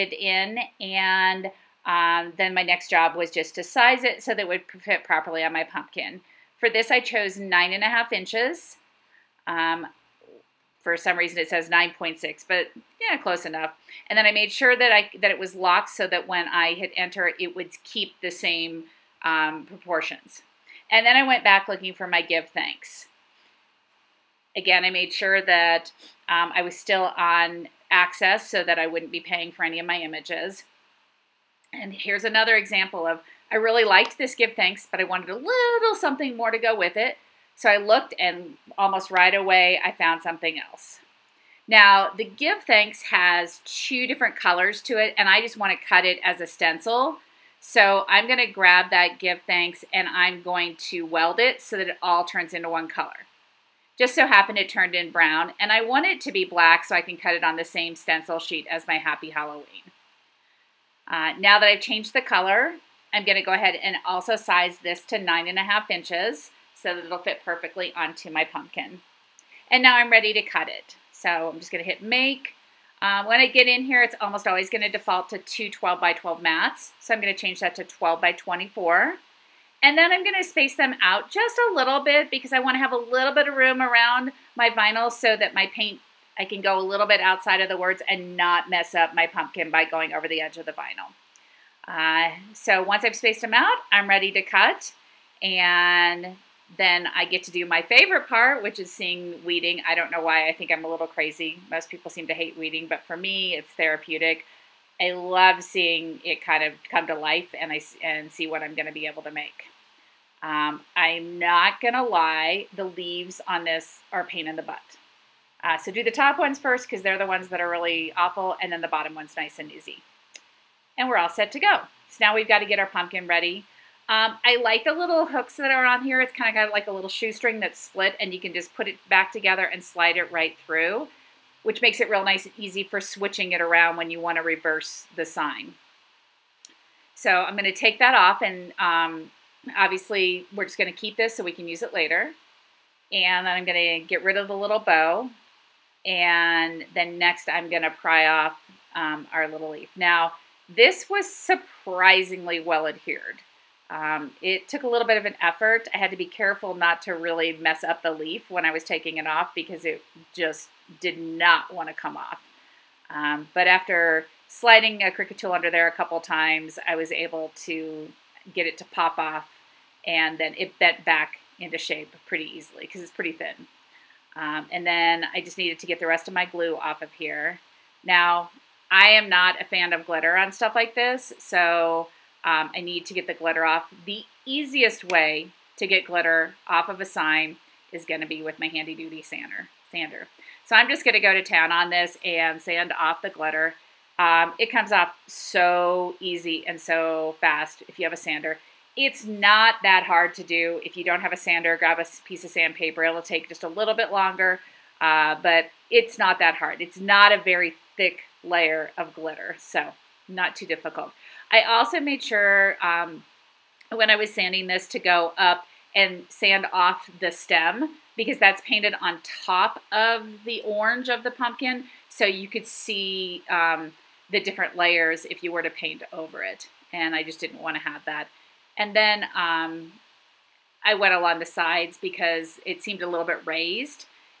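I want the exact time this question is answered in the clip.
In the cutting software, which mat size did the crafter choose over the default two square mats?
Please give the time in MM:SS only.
01:17.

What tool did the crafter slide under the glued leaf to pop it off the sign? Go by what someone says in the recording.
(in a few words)
Cricut tool.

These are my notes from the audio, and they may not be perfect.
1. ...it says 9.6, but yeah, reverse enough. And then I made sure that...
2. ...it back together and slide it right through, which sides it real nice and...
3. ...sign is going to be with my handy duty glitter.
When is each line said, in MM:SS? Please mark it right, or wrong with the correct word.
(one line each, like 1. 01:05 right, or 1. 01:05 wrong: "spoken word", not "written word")
1. 00:11 wrong: "close", not "reverse"
2. 02:08 wrong: "makes", not "sides"
3. 03:07 wrong: "sander", not "glitter".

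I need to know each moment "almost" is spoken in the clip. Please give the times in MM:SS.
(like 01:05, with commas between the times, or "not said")
00:38, 01:14.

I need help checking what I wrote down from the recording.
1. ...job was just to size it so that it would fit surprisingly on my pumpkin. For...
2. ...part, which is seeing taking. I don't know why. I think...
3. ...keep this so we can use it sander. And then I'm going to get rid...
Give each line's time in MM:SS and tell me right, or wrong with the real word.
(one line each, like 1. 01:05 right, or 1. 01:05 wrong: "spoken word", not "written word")
1. 00:02 wrong: "properly", not "surprisingly"
2. 01:38 wrong: "weeding", not "taking"
3. 02:20 wrong: "later", not "sander".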